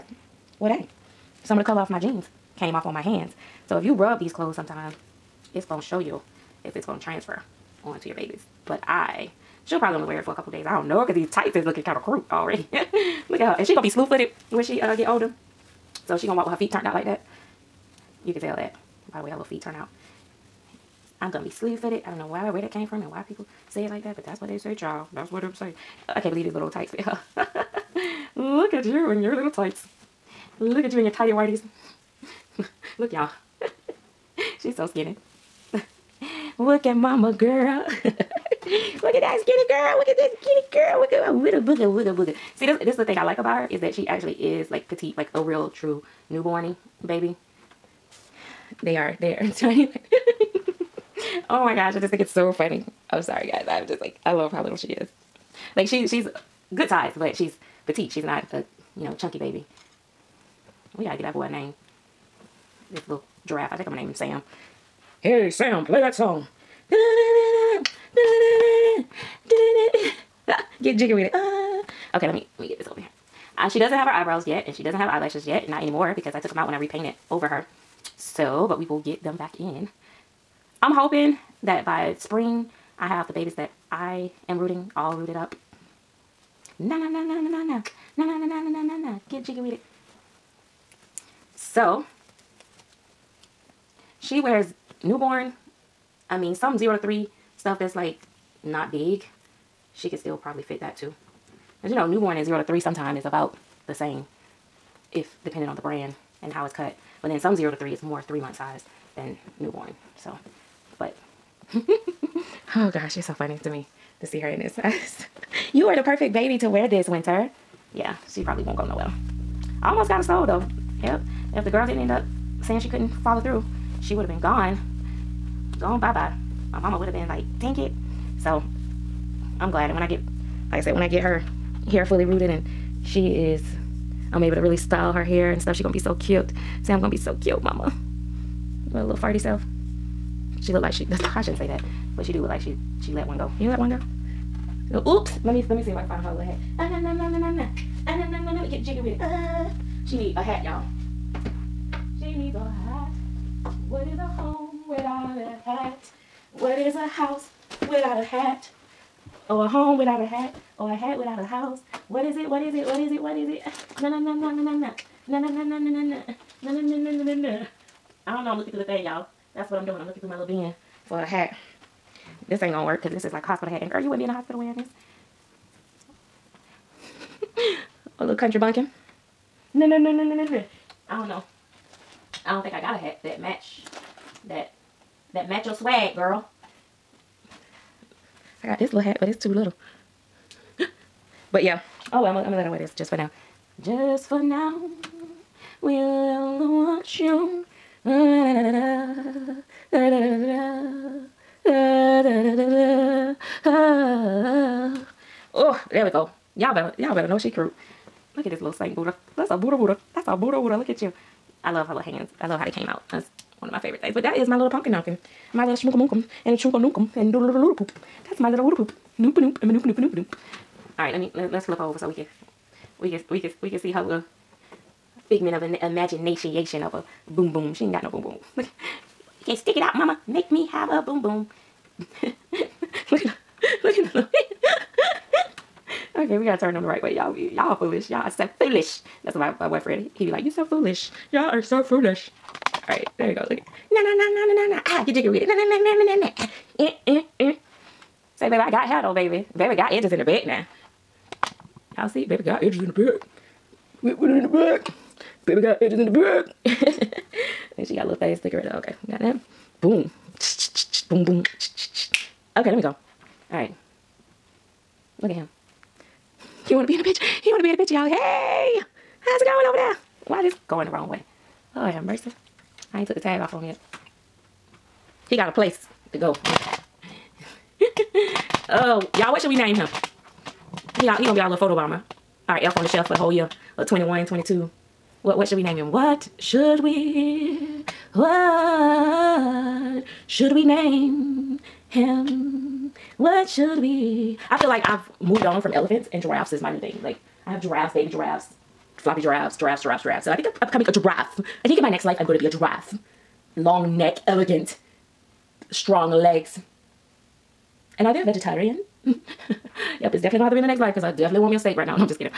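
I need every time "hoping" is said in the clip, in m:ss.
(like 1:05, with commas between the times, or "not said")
1:20.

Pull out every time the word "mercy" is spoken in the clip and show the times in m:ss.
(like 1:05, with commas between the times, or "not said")
4:32.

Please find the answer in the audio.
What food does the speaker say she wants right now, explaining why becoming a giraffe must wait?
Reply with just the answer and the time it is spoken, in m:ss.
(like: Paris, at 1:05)
steak, at 5:11.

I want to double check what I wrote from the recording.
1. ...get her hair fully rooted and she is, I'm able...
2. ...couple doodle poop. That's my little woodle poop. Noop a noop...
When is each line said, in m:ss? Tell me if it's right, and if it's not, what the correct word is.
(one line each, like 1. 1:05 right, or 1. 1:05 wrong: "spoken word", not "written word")
1. 2:11 right
2. 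3:37 wrong: "doodle", not "couple".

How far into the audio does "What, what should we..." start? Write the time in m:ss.
4:45.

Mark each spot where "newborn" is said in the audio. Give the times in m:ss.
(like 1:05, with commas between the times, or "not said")
0:46, 1:35, 1:42, 1:49.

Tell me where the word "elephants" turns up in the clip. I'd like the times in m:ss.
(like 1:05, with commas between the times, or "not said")
4:55.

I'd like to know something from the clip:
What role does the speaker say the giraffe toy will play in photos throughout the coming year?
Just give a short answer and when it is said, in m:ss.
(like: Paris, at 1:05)
photo bomber, at 4:41.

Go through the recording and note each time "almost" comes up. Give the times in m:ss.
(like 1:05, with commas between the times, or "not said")
1:59.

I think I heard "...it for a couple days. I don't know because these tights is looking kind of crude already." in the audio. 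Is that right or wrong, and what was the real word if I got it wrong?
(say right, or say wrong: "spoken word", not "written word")
right.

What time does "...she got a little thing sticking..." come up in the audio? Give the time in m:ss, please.
4:17.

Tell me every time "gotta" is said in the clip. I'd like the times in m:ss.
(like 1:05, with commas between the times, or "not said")
1:01, 3:56.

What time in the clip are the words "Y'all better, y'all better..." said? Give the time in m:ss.
3:26.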